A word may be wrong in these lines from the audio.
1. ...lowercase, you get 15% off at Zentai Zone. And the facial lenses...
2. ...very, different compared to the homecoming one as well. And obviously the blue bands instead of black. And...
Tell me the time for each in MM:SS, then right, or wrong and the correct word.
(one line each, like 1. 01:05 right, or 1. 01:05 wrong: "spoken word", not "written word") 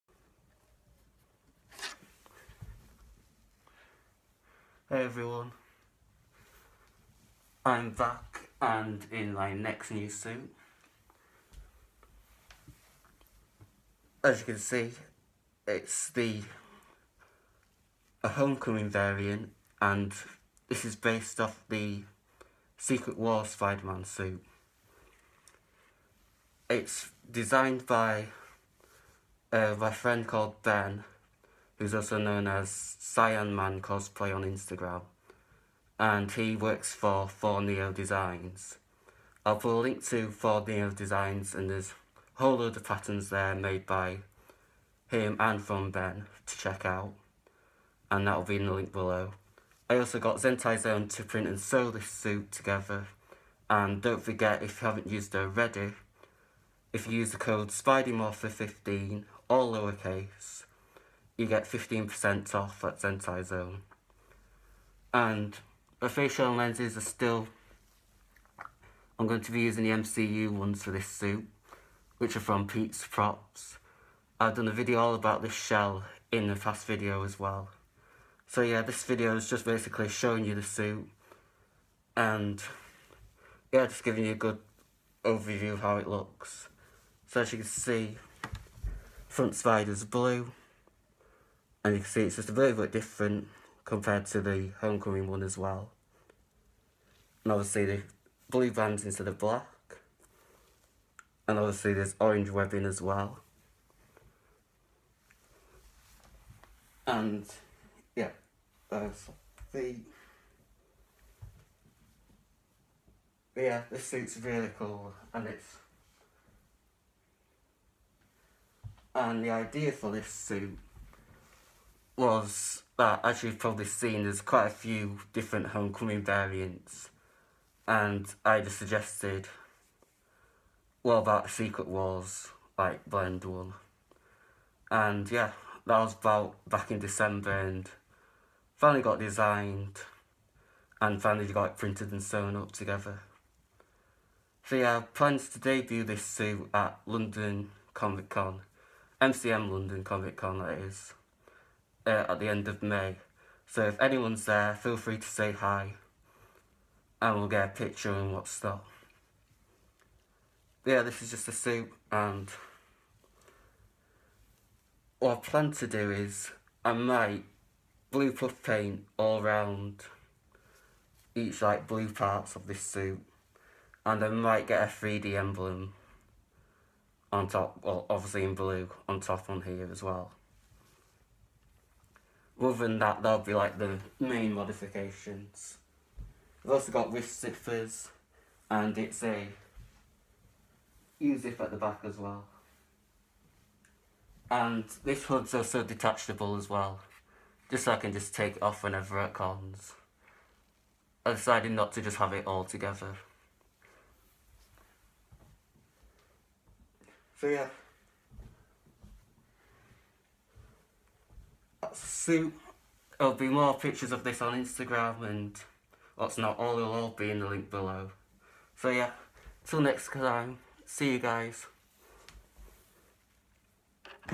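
1. 00:59 right
2. 01:32 right.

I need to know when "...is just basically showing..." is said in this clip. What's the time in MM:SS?
01:19.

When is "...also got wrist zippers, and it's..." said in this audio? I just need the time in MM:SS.
03:06.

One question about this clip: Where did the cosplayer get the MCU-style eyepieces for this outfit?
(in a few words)
Pete's Props.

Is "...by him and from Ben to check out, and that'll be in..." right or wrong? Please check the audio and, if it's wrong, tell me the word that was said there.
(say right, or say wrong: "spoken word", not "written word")
right.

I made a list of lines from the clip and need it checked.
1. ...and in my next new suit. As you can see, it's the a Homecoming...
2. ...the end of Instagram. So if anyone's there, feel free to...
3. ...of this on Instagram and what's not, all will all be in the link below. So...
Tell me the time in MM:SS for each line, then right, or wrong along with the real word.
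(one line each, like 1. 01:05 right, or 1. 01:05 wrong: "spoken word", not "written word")
1. 00:08 right
2. 02:32 wrong: "May", not "Instagram"
3. 03:34 right.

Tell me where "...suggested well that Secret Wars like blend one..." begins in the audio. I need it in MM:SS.
02:08.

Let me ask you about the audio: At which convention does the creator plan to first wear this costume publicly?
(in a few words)
MCM London Comic Con.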